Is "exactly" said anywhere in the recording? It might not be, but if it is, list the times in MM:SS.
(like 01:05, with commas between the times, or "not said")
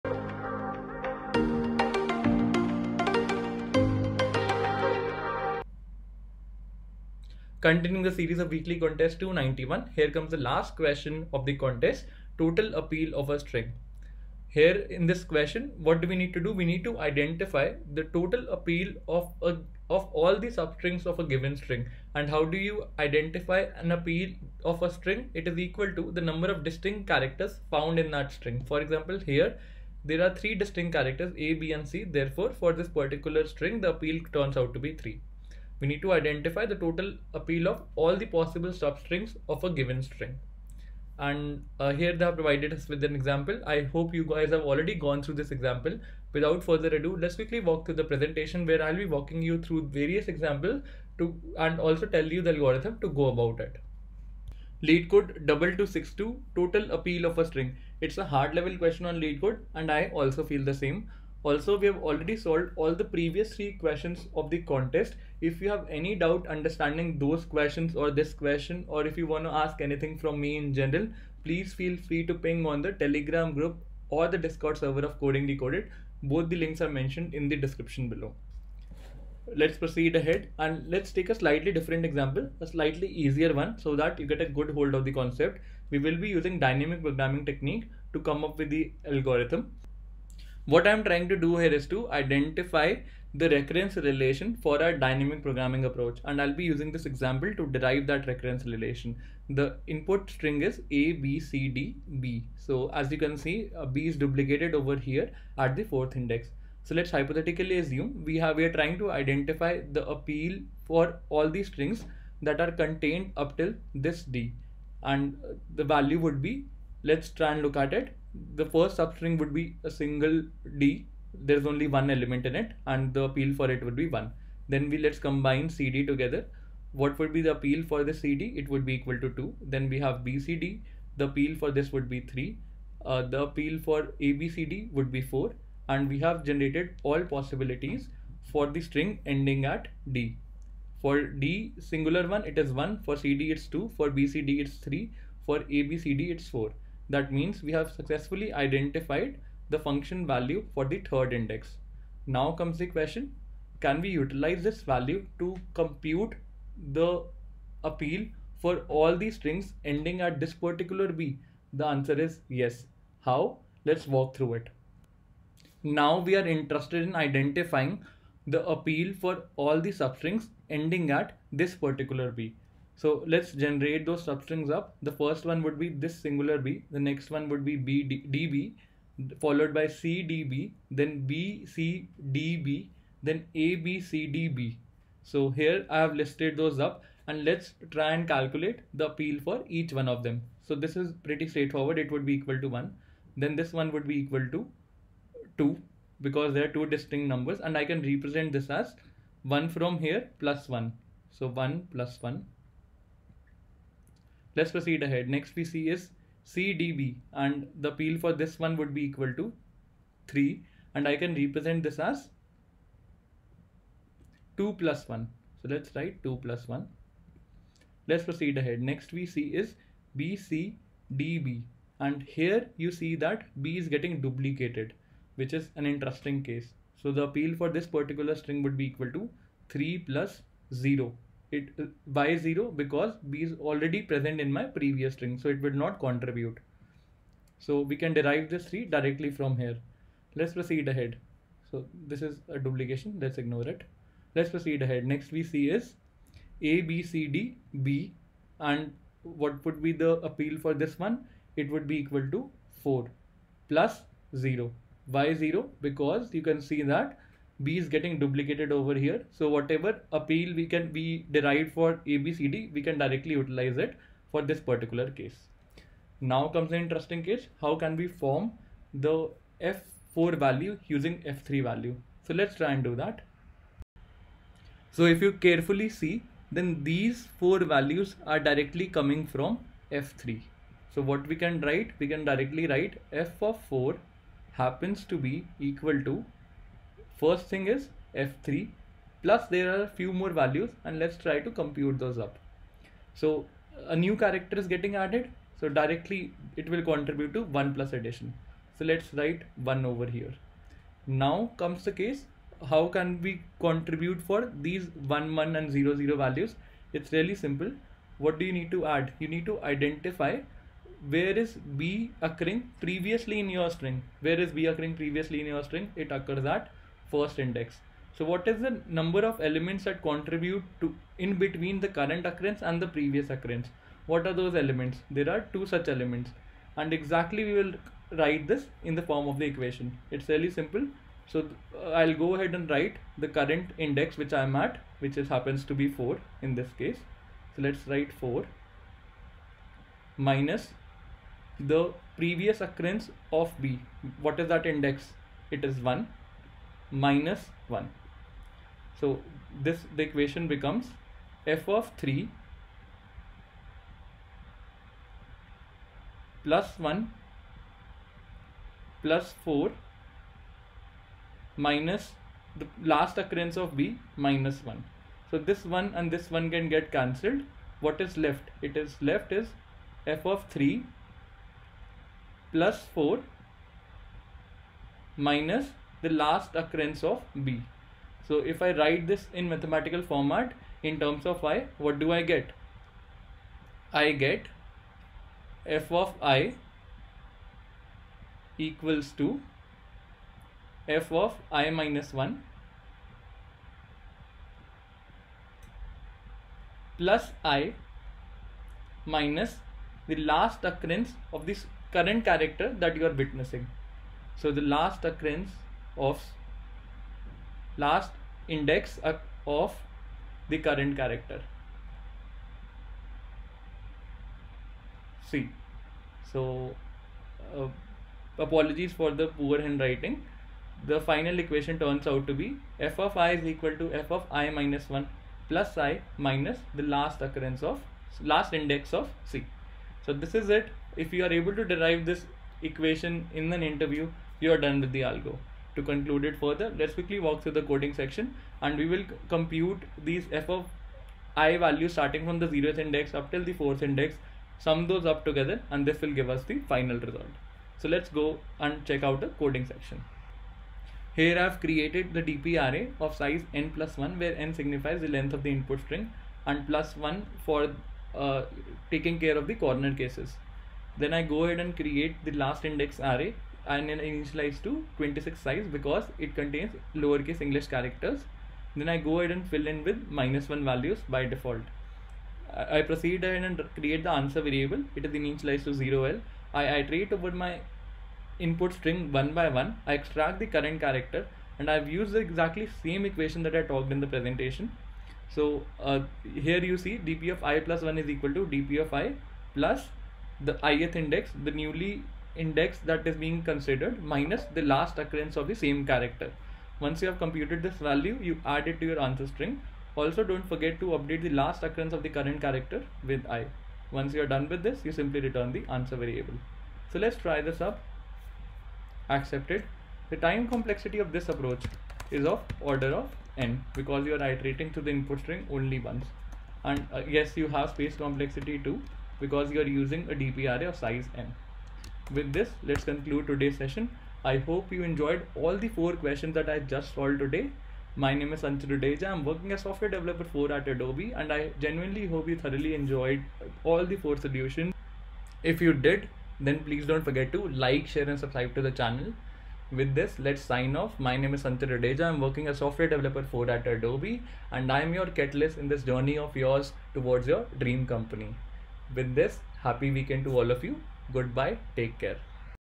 05:26, 08:02.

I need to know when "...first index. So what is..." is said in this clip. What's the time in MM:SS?
05:17.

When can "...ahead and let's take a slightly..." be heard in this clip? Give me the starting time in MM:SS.
01:20.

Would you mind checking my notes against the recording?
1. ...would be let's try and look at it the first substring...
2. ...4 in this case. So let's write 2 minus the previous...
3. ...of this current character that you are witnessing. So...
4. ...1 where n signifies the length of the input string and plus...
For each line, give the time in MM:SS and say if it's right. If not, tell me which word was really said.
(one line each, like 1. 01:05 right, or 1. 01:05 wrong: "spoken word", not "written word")
1. 01:56 right
2. 05:35 wrong: "4", not "2"
3. 06:41 right
4. 07:33 right.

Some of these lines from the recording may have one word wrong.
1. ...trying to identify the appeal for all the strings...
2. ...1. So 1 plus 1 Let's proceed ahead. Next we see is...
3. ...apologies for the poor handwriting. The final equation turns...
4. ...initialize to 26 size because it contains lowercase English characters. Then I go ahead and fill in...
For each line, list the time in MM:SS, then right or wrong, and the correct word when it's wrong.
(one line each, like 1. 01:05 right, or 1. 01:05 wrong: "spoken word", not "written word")
1. 01:48 right
2. 03:20 right
3. 06:58 right
4. 07:43 right.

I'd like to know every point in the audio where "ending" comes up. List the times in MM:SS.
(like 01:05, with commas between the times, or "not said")
02:19, 02:39, 02:50.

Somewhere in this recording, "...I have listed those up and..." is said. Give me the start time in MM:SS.
03:05.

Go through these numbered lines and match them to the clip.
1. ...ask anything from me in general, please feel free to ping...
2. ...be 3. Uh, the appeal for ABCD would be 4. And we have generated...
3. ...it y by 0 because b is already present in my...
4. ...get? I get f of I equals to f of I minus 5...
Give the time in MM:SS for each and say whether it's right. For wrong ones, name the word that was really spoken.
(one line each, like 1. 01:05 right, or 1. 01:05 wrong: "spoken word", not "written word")
1. 01:09 right
2. 02:12 right
3. 03:51 right
4. 06:22 wrong: "1", not "5".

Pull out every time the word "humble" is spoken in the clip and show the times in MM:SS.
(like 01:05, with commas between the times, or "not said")
not said.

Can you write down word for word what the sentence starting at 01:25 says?
We will be using dynamic programming technique to come up with the algorithm.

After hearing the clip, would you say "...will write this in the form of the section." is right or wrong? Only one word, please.
wrong.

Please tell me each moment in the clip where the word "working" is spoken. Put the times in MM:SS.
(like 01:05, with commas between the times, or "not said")
08:49, 09:02.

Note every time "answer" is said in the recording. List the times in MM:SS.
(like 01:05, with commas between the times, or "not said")
02:41, 07:54, 08:18, 08:25.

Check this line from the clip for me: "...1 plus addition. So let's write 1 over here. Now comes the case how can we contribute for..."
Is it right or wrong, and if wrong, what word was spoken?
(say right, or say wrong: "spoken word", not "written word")
right.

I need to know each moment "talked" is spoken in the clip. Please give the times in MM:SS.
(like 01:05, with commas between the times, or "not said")
08:03.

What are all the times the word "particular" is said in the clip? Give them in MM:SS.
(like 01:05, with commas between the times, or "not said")
00:32, 02:40, 02:51, 03:47, 04:24.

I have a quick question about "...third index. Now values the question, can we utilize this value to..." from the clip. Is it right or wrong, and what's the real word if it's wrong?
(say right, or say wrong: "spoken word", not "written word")
wrong: "comes", not "values".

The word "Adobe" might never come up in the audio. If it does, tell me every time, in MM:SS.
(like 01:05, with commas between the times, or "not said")
08:50, 09:03.